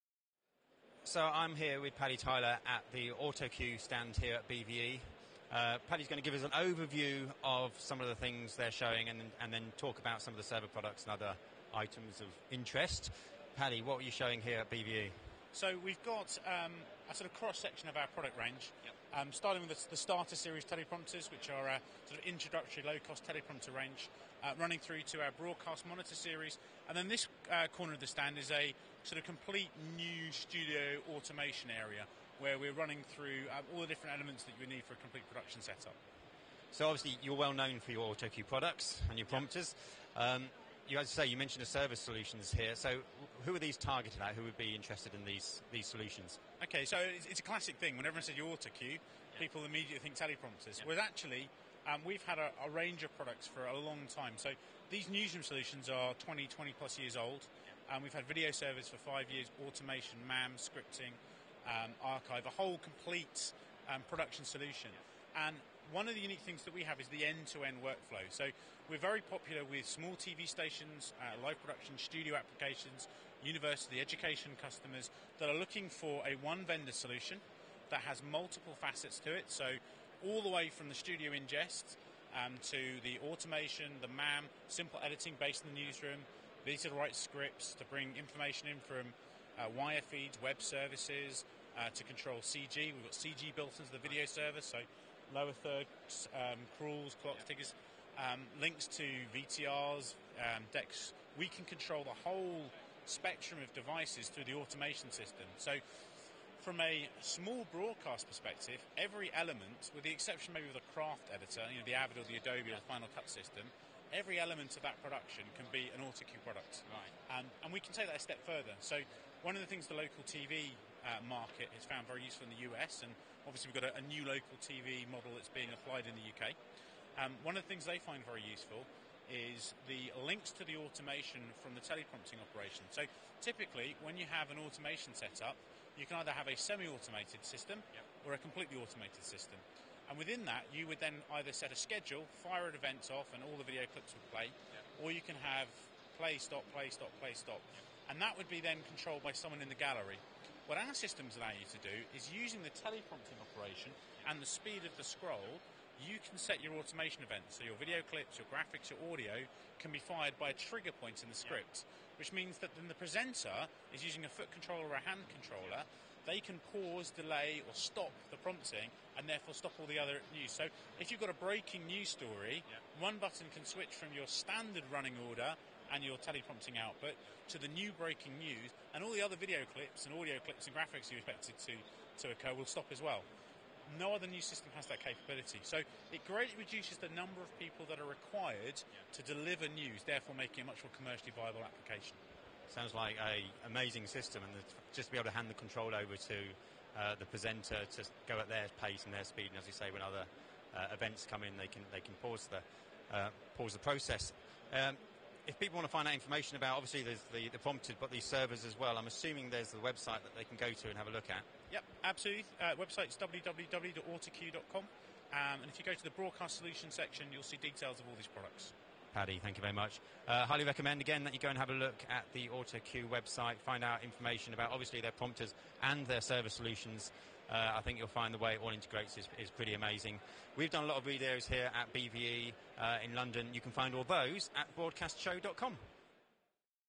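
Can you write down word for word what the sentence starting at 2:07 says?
Um, one of the things they find very useful is the links to the automation from the teleprompting operation.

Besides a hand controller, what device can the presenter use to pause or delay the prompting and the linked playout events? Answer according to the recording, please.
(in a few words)
Foot controller.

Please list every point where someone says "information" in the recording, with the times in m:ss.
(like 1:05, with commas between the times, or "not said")
1:28, 3:26, 3:44.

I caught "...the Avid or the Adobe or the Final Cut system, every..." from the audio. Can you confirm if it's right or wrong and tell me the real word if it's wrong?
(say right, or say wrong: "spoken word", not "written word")
right.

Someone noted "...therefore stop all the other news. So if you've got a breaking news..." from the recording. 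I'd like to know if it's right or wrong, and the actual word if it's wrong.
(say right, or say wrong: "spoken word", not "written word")
right.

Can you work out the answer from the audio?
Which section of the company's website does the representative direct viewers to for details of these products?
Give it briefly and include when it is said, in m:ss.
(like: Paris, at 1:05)
Broadcast solution section, at 3:36.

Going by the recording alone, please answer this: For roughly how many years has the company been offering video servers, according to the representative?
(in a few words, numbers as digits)
5 years.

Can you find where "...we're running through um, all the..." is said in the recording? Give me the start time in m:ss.
0:32.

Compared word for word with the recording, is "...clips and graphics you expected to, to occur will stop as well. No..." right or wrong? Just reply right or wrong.
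right.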